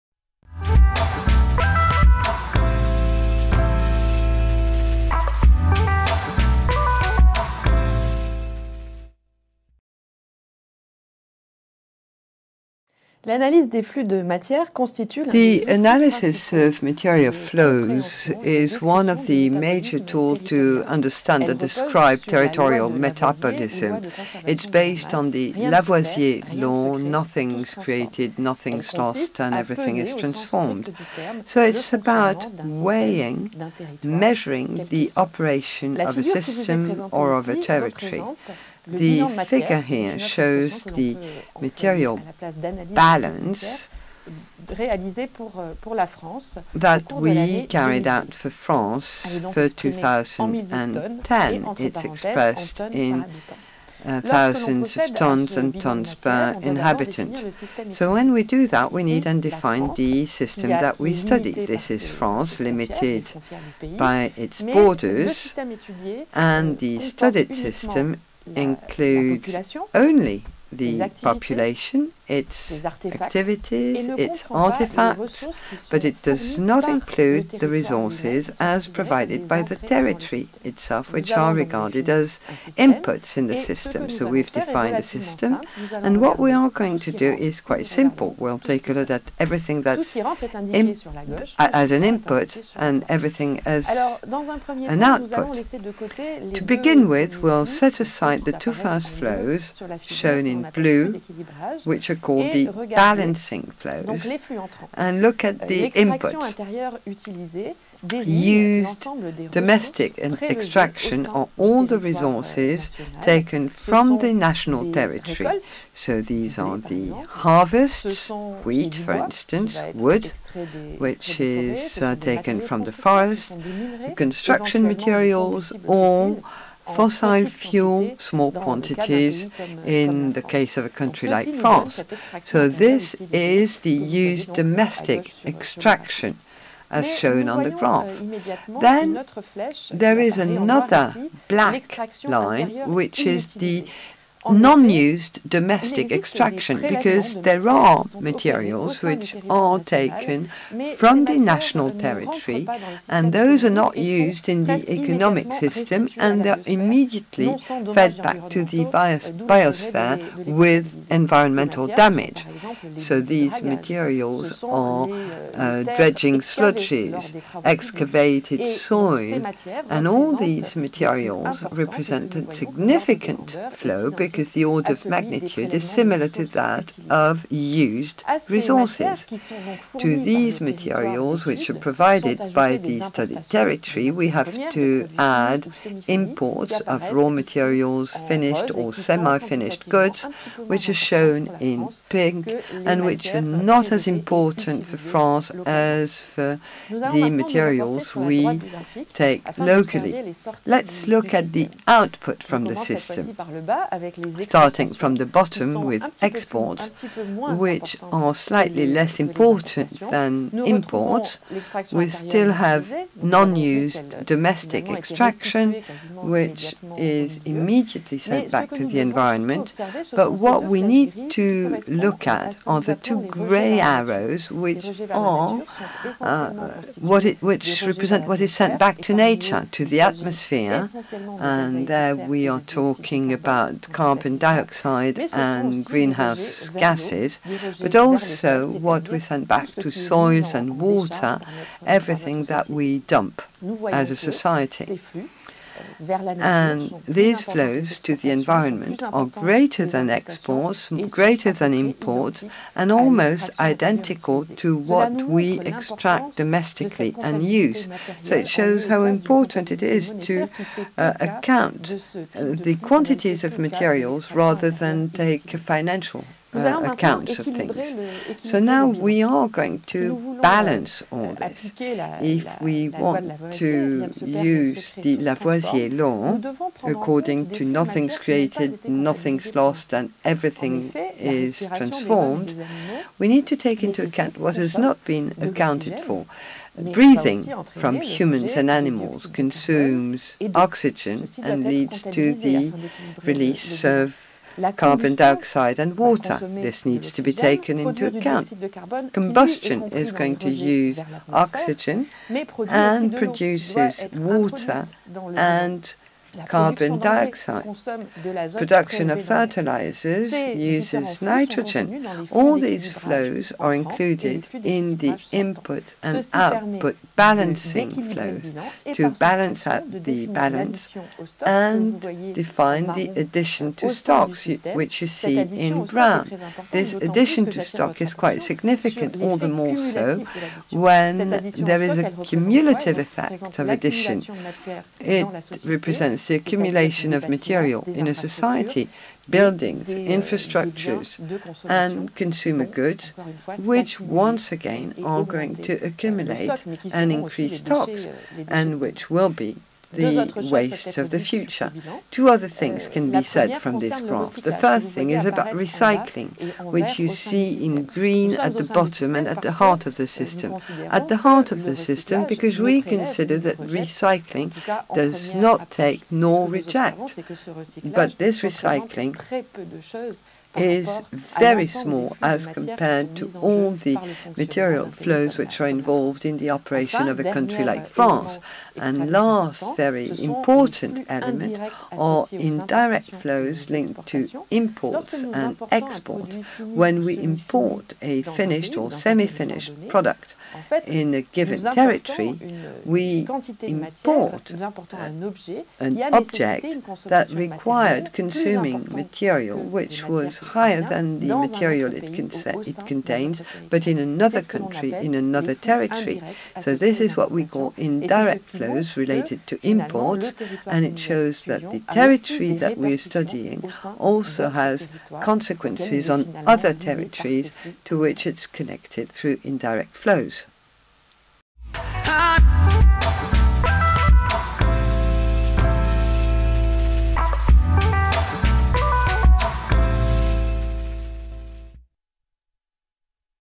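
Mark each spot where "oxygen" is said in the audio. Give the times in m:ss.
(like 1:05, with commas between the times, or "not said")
4:50, 5:01.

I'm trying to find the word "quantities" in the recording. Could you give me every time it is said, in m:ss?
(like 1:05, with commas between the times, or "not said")
2:08, 4:22.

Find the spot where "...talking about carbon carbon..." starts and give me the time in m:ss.
3:52.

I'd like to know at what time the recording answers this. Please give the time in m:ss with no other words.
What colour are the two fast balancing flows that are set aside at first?
1:40.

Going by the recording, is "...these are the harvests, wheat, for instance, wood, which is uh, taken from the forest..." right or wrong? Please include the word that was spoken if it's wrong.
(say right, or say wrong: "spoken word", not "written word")
right.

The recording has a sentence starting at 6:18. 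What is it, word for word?
And last very important element are indirect flows linked to imports and exports.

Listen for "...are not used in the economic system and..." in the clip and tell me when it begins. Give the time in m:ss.
2:33.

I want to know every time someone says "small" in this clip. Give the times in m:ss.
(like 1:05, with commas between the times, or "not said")
2:08, 6:11.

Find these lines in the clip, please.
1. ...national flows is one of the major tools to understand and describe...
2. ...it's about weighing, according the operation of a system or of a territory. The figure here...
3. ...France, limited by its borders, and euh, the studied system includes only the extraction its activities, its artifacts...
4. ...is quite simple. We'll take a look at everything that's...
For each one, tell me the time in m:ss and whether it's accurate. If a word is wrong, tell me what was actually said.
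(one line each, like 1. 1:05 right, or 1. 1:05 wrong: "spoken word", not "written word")
1. 0:16 wrong: "material", not "national"
2. 0:31 wrong: "measuring", not "according"
3. 1:02 wrong: "population", not "extraction"
4. 1:27 right.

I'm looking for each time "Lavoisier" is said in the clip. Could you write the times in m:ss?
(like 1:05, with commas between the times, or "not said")
0:25, 4:35.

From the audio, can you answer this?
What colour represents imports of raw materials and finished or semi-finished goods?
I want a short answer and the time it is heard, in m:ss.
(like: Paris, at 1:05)
pink, at 3:12.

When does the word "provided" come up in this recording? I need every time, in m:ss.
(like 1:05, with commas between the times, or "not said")
1:18, 3:01.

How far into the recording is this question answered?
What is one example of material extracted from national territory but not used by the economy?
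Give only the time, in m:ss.
2:45.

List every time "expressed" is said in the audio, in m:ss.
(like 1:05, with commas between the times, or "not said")
0:52.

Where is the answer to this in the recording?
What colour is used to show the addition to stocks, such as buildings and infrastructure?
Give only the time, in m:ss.
5:25.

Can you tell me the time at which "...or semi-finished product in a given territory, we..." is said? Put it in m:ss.
6:28.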